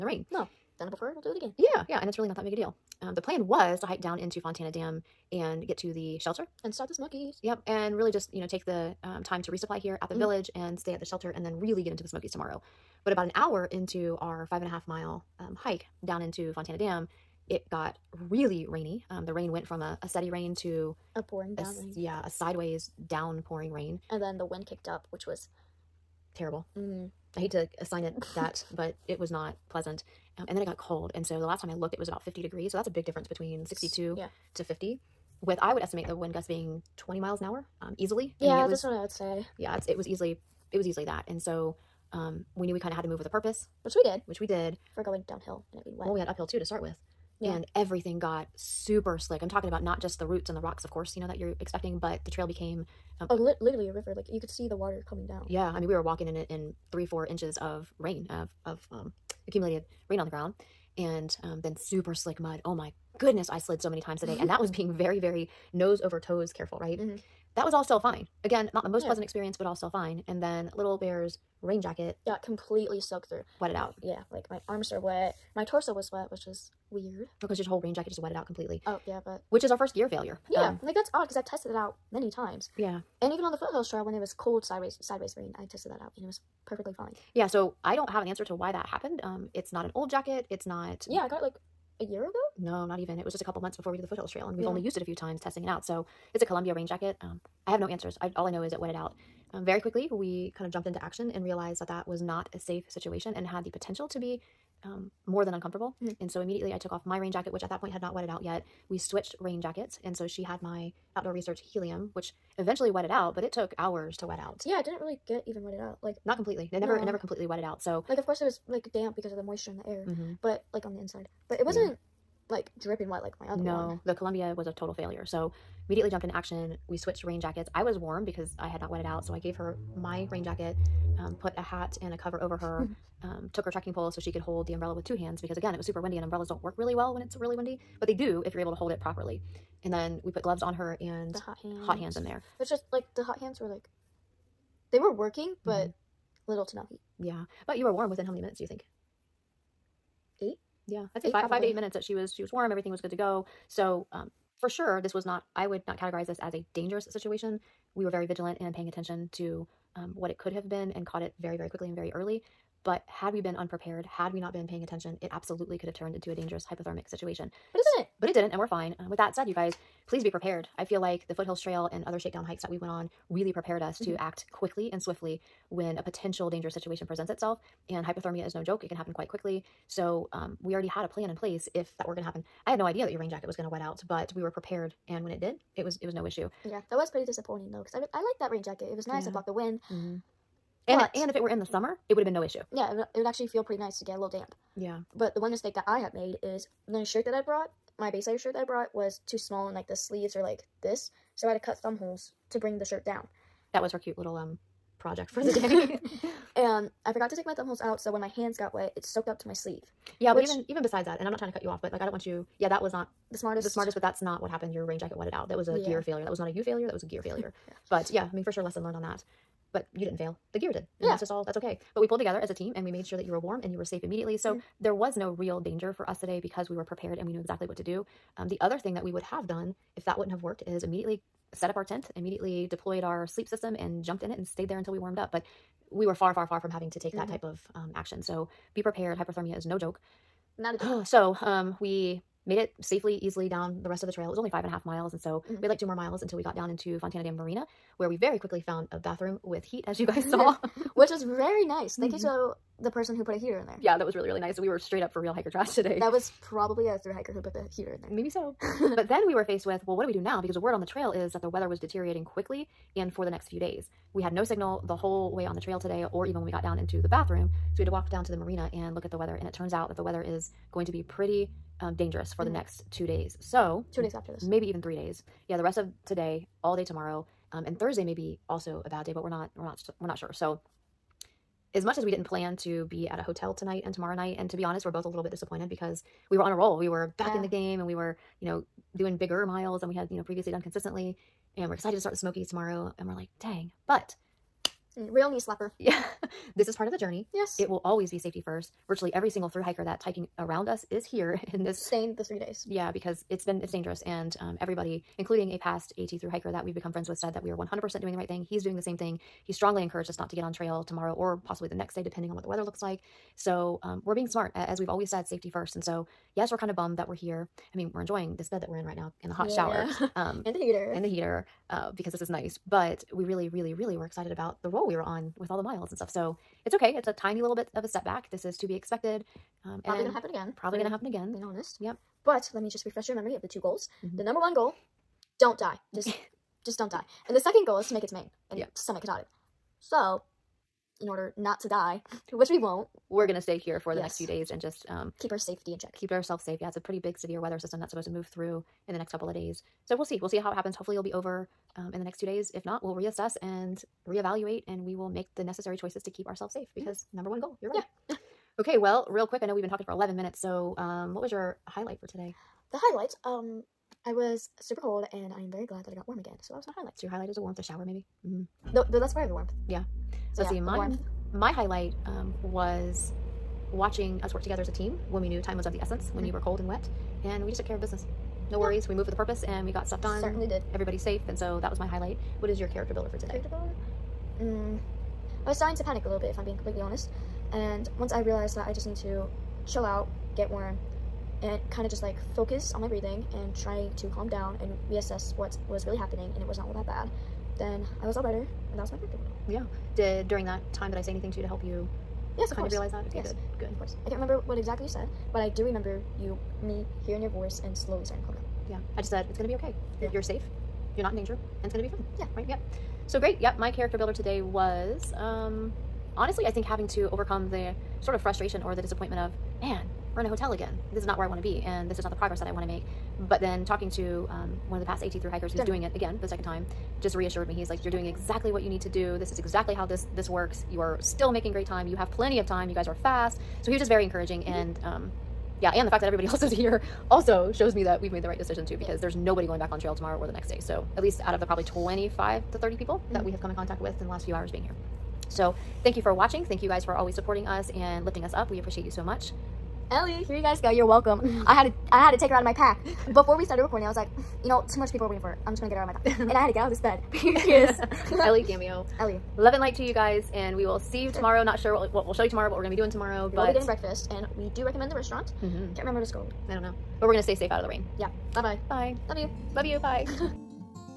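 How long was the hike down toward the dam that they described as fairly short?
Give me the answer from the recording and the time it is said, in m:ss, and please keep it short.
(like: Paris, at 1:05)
5.5 miles, at 4:04.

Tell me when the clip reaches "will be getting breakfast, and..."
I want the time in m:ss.
7:43.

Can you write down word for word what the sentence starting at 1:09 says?
pleasant experience, but all still fine.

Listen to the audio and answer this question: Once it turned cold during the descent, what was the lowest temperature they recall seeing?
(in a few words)
50 degrees.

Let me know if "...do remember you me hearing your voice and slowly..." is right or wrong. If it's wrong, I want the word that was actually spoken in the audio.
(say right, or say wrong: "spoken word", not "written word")
right.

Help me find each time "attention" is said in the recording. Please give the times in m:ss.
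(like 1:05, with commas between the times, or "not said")
2:38, 2:44.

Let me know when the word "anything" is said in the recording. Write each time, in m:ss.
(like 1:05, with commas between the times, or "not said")
6:41.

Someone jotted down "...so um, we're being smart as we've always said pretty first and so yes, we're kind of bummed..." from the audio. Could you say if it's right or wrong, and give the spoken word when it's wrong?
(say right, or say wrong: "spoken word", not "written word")
wrong: "safety", not "pretty".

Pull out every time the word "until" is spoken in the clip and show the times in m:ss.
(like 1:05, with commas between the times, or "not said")
3:54, 4:06.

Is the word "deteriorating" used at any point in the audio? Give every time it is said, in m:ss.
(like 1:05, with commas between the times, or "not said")
4:21.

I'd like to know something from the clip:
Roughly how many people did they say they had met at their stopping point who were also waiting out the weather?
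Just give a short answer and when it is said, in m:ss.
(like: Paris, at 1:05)
25 to 30, at 7:21.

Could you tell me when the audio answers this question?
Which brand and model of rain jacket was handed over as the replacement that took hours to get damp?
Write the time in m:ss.
1:51.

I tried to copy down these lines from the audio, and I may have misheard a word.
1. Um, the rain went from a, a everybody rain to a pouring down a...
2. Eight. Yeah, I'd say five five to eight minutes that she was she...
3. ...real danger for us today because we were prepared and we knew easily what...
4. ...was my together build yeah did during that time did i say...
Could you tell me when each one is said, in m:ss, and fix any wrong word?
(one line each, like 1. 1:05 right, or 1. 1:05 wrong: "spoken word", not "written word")
1. 0:19 wrong: "steady", not "everybody"
2. 2:30 right
3. 3:45 wrong: "exactly", not "easily"
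4. 6:38 wrong: "character", not "together".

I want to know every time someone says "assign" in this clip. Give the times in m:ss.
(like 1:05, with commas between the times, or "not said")
0:27.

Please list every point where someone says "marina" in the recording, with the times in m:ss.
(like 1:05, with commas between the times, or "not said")
4:07, 4:28.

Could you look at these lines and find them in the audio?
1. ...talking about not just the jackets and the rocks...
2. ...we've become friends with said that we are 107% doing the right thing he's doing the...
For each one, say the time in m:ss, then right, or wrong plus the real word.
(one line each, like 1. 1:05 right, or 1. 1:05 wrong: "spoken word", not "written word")
1. 0:49 wrong: "roots", not "jackets"
2. 5:06 wrong: "100", not "107".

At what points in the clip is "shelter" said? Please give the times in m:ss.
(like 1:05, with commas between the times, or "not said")
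0:06, 0:11.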